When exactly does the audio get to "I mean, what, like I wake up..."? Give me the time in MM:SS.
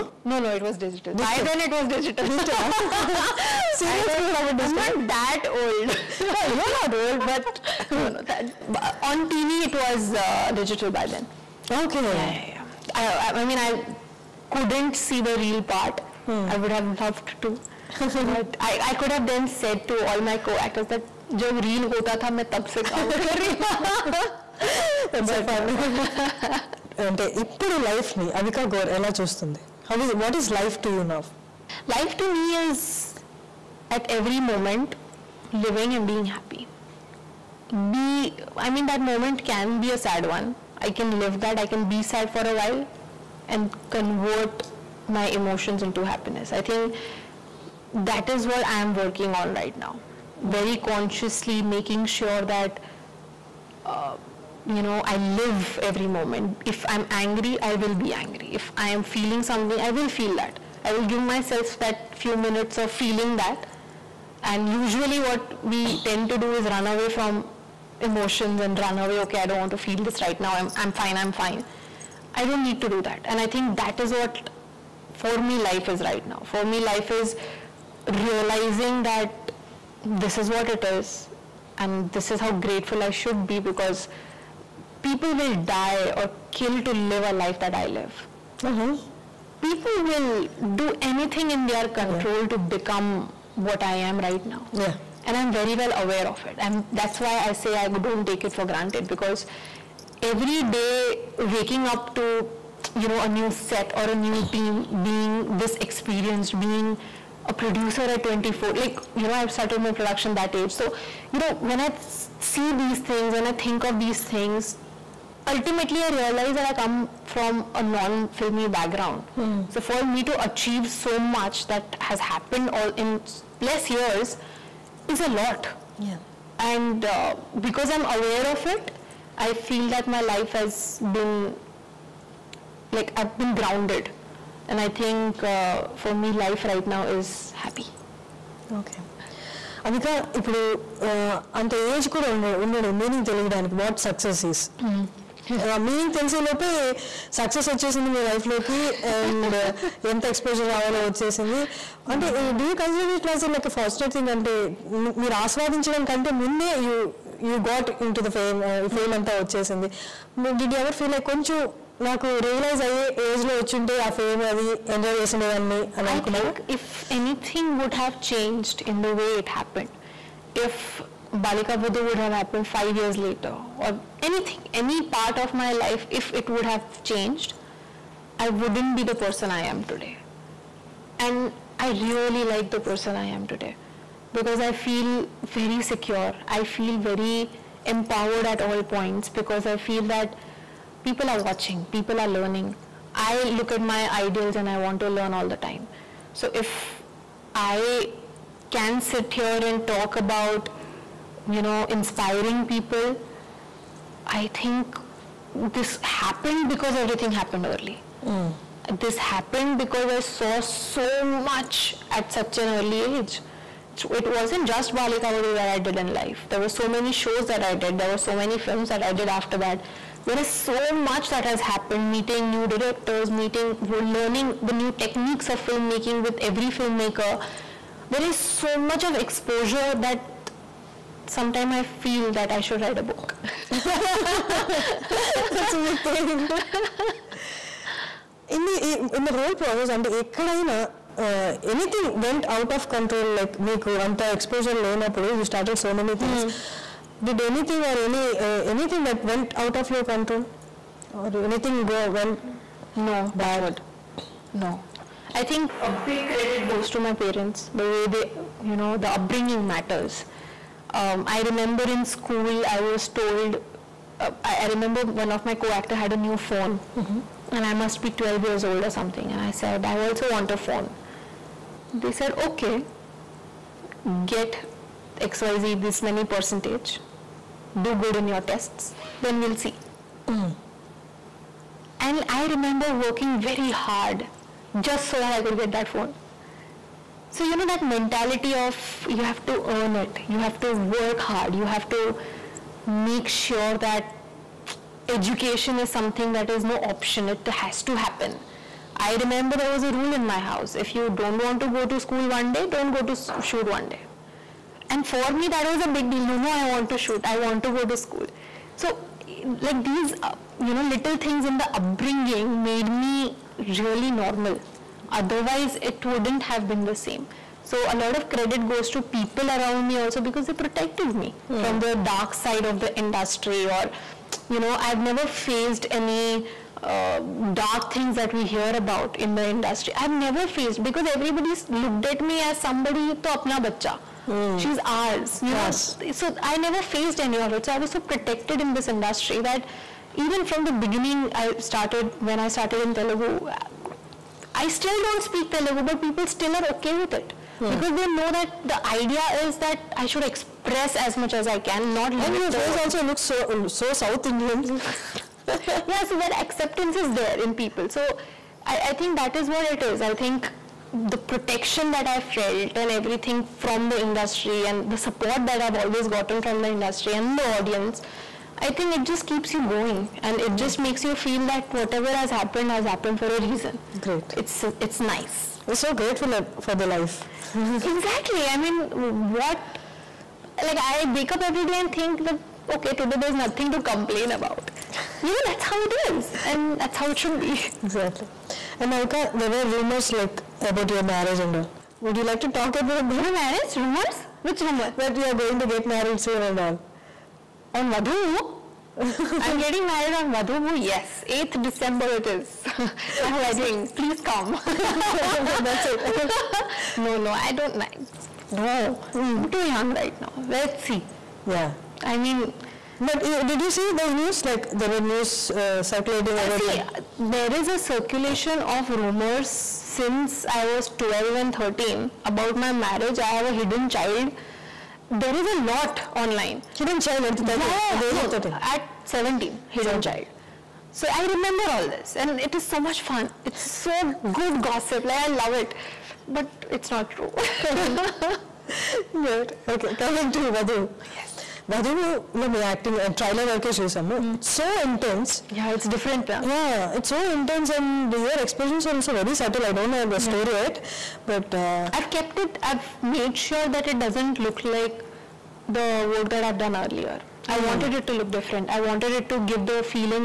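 06:18.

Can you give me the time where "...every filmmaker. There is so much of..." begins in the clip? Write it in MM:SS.
03:46.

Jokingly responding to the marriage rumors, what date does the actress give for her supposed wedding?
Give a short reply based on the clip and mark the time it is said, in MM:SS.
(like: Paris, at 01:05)
8 December, at 06:41.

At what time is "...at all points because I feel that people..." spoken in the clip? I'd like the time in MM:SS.
03:08.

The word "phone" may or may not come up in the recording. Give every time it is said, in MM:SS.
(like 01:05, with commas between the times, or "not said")
04:26, 04:30, 04:45.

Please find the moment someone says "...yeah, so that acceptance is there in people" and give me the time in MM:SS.
05:55.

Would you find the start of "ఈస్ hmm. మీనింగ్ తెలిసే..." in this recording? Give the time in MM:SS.
02:24.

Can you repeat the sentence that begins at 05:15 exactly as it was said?
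Otherwise, it wouldn't have been the same.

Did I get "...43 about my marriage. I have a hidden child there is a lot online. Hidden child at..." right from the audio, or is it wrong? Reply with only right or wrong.
wrong.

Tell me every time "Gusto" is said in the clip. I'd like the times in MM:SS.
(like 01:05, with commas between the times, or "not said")
not said.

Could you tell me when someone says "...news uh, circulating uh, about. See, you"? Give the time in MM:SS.
06:55.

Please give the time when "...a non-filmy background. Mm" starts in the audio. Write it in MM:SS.
01:57.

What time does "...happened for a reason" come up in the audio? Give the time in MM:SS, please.
06:12.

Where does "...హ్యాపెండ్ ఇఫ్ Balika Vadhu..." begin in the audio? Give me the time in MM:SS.
02:49.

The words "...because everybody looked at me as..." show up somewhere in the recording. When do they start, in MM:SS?
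05:30.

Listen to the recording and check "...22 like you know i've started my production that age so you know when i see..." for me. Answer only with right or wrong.
wrong.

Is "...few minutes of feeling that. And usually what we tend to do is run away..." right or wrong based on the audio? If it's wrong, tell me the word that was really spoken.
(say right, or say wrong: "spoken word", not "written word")
right.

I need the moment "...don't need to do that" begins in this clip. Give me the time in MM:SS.
01:12.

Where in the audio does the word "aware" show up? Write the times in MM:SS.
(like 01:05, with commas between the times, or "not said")
01:35, 02:08.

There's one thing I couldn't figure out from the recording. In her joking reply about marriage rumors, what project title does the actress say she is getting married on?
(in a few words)
Vadhuvu.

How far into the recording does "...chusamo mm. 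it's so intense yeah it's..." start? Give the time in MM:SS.
07:23.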